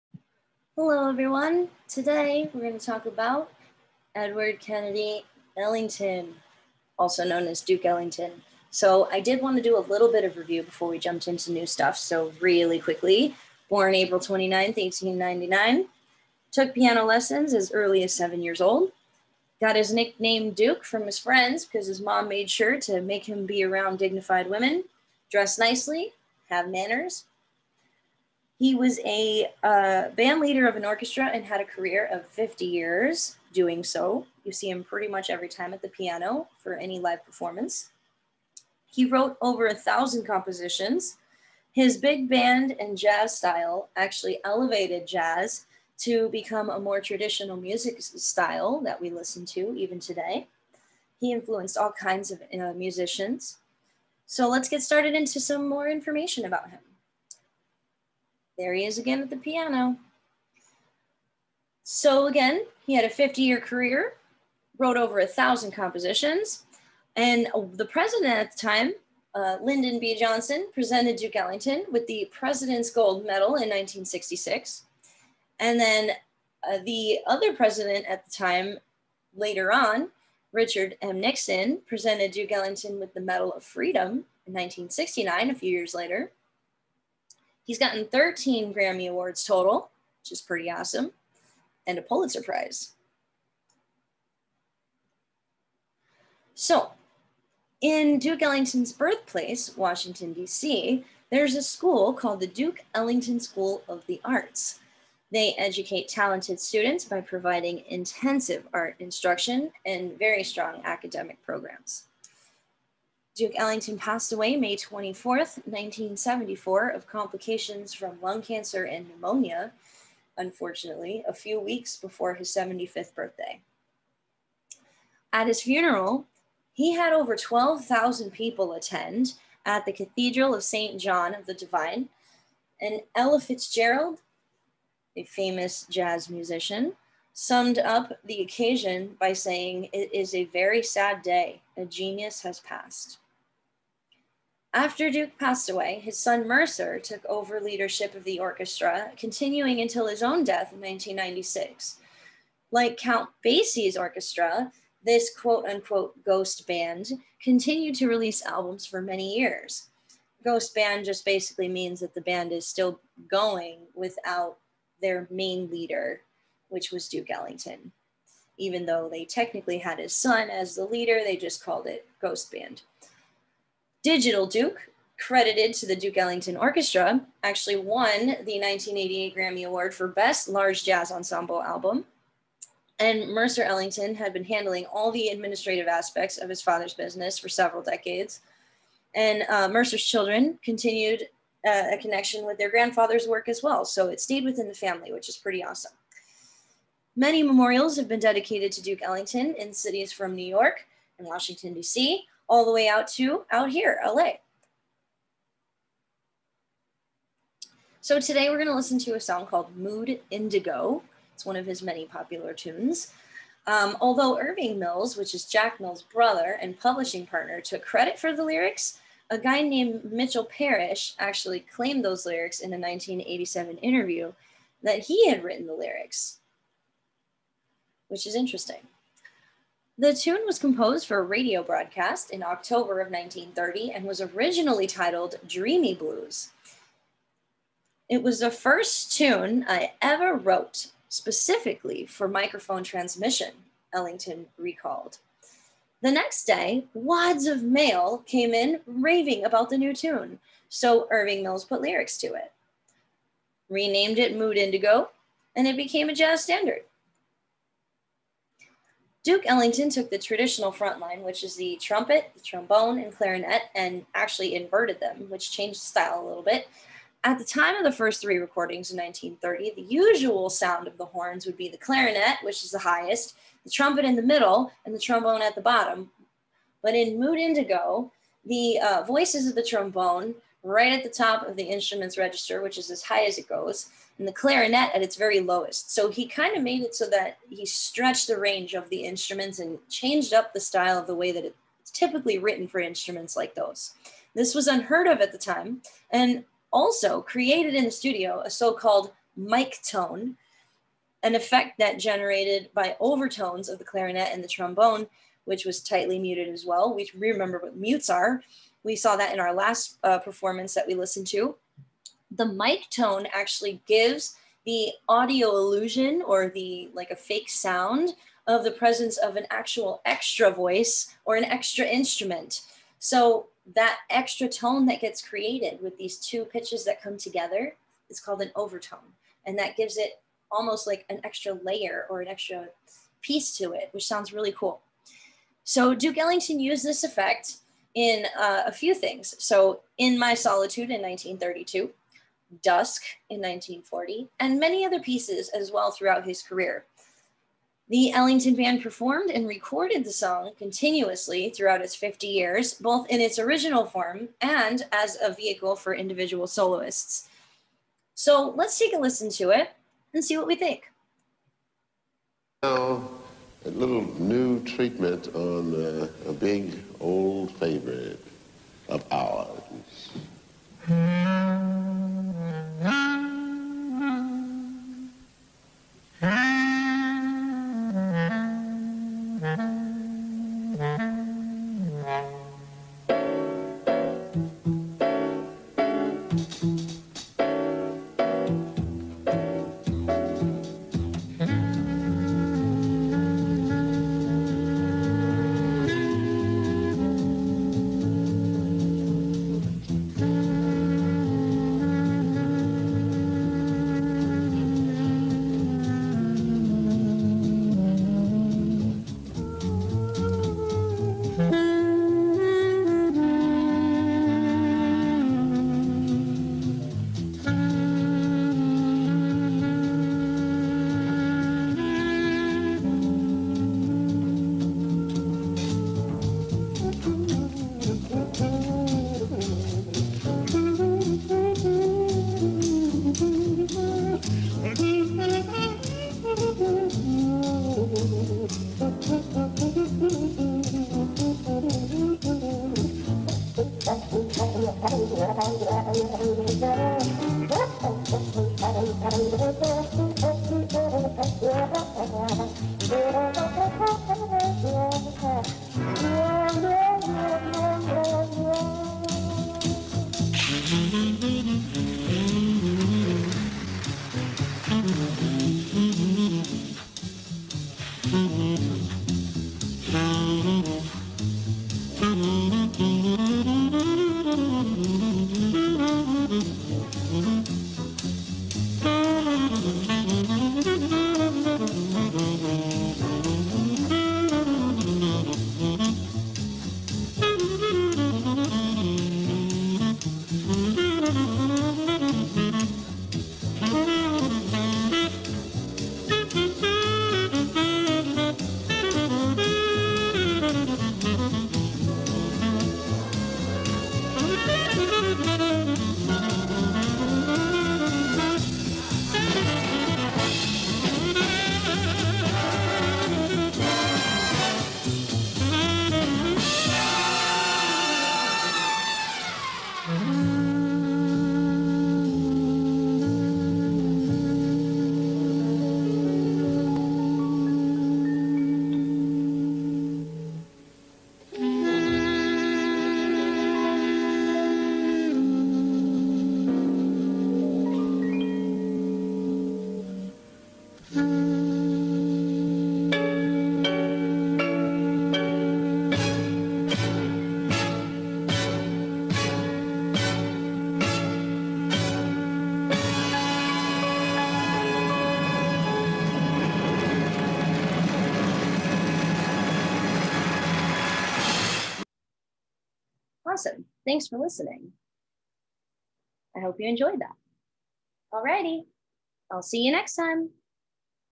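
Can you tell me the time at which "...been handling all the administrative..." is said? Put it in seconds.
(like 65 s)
184 s.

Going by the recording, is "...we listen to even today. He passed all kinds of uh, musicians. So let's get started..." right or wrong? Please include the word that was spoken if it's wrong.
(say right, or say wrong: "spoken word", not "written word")
wrong: "influenced", not "passed".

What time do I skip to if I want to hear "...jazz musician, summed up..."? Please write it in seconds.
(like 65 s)
135 s.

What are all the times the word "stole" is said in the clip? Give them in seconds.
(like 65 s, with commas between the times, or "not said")
not said.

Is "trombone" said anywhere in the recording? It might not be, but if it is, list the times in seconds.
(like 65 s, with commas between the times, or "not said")
262 s, 274 s, 279 s, 304 s.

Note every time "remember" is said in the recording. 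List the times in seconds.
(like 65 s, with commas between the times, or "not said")
307 s.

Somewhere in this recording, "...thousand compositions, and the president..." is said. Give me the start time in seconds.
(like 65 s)
65 s.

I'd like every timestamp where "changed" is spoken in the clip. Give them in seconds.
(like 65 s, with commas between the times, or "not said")
265 s, 289 s.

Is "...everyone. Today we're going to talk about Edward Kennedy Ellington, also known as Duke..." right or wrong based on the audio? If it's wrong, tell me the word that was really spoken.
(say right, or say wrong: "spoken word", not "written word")
right.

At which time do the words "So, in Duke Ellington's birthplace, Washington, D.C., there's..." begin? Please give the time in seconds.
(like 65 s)
96 s.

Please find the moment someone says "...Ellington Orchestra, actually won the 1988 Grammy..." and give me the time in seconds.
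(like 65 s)
176 s.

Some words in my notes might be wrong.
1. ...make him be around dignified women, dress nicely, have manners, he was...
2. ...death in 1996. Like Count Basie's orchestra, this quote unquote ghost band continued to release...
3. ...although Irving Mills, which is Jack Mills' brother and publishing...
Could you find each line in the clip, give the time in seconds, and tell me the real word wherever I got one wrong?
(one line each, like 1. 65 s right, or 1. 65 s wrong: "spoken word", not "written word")
1. 23 s right
2. 150 s right
3. 213 s right.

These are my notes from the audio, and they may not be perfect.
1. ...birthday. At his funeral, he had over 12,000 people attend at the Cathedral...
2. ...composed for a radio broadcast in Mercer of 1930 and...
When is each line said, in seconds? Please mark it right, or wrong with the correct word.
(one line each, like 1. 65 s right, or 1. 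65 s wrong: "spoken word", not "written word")
1. 123 s right
2. 230 s wrong: "October", not "Mercer".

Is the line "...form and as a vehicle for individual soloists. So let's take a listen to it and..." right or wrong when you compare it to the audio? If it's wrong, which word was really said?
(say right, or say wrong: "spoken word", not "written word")
right.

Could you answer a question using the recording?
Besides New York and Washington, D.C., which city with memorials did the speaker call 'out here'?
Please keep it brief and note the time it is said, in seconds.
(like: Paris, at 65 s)
LA, at 204 s.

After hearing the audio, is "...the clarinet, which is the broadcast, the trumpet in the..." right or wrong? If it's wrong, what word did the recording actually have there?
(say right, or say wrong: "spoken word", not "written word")
wrong: "highest", not "broadcast".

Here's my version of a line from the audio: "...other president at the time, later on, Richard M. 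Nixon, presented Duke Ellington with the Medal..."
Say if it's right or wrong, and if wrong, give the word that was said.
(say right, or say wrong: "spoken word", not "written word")
right.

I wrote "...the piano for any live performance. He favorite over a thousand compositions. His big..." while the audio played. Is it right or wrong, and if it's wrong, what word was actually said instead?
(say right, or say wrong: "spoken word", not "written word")
wrong: "wrote", not "favorite".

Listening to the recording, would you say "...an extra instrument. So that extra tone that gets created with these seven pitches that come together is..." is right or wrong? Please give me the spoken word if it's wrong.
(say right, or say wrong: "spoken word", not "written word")
wrong: "two", not "seven".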